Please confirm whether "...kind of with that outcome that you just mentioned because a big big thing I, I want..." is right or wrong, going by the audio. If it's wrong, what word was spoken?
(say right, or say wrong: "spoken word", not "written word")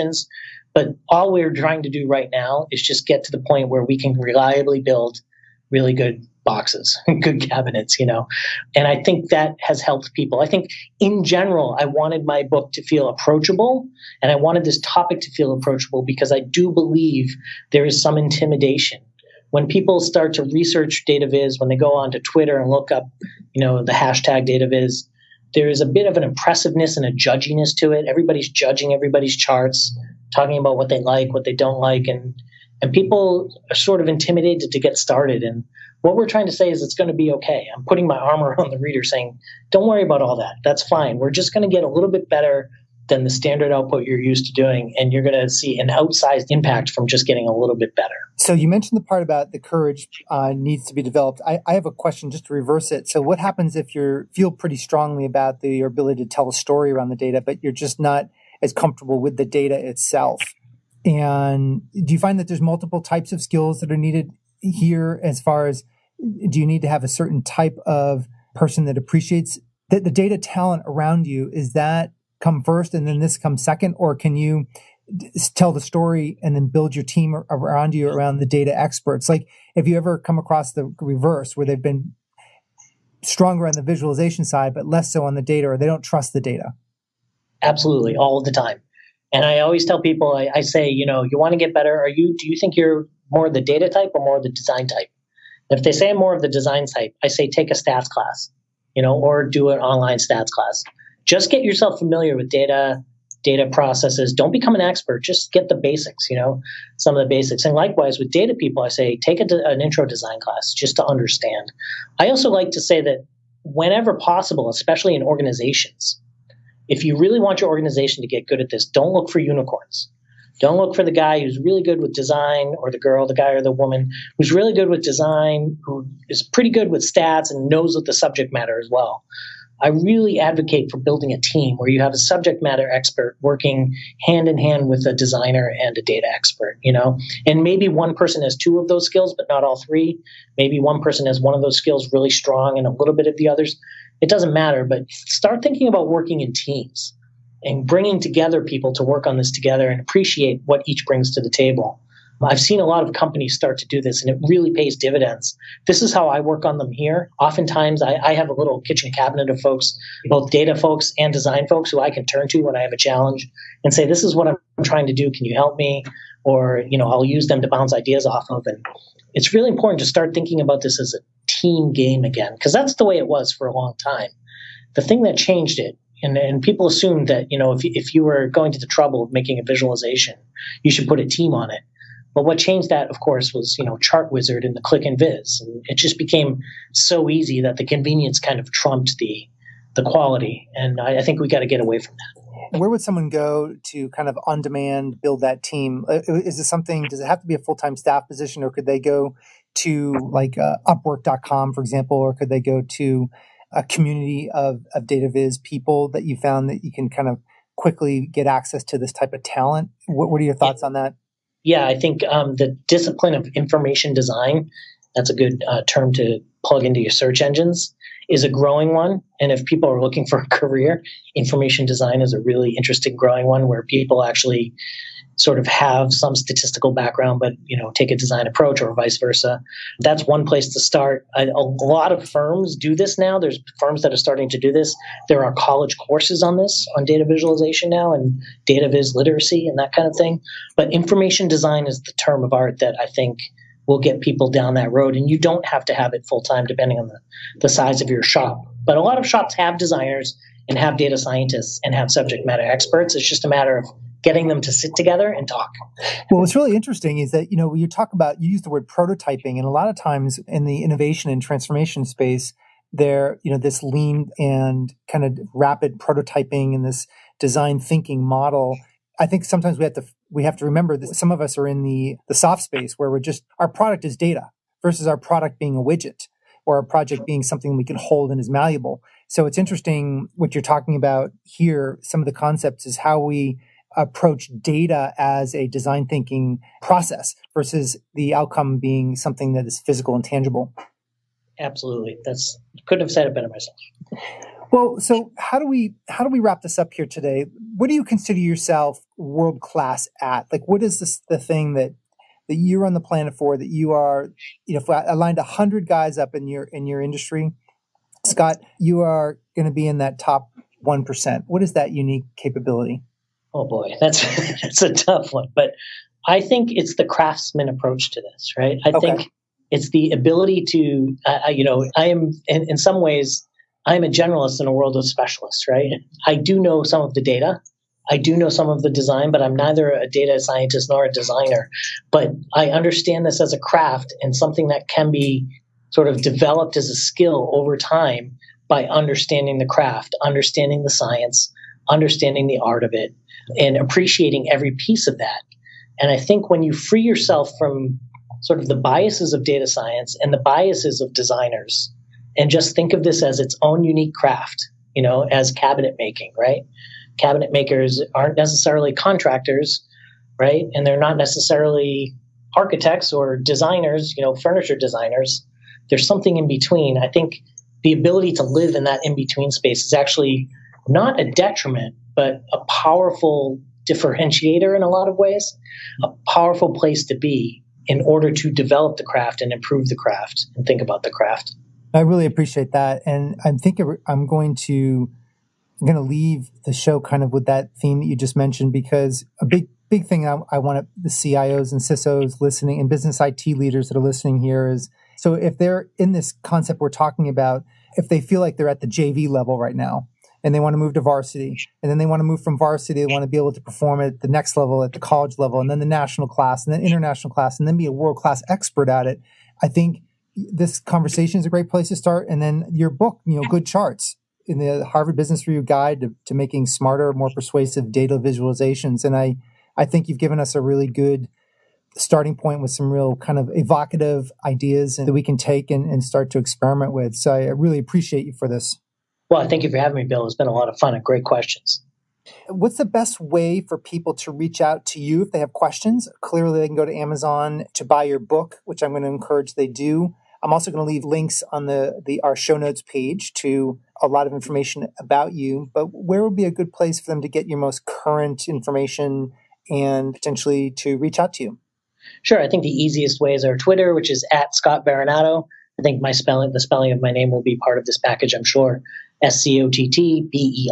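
wrong: "theme", not "outcome".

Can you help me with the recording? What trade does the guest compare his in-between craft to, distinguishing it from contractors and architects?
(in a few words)
Cabinet making.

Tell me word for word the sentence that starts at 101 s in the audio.
Just get yourself familiar with data, data processes.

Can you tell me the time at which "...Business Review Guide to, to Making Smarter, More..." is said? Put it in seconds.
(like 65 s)
415 s.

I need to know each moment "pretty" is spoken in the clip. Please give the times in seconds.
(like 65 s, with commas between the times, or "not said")
54 s, 126 s.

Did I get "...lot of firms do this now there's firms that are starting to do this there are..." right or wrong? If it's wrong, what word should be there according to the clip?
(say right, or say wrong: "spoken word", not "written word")
right.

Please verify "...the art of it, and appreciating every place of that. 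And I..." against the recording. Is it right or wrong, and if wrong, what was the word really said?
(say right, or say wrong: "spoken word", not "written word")
wrong: "piece", not "place".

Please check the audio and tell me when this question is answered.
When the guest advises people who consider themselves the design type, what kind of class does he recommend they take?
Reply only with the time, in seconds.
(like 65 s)
97 s.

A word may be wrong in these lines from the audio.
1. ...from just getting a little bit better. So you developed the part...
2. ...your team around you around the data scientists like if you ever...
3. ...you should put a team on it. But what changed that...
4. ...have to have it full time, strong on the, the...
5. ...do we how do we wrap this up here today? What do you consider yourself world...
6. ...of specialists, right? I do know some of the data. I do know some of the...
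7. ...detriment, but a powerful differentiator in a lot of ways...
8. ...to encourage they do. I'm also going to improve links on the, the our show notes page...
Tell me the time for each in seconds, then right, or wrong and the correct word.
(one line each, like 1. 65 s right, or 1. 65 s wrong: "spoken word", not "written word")
1. 46 s wrong: "mentioned", not "developed"
2. 76 s wrong: "experts", not "scientists"
3. 180 s right
4. 245 s wrong: "depending", not "strong"
5. 295 s right
6. 324 s right
7. 371 s right
8. 439 s wrong: "leave", not "improve".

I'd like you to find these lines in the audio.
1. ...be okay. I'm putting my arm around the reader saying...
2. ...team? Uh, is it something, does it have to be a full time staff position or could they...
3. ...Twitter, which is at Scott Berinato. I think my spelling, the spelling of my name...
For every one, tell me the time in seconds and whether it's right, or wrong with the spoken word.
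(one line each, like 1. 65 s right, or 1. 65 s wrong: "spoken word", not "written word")
1. 37 s right
2. 195 s right
3. 453 s right.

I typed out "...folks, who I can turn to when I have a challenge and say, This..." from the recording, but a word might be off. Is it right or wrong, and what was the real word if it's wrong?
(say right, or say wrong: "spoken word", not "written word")
right.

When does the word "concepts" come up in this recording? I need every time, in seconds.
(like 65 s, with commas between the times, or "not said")
282 s, 396 s.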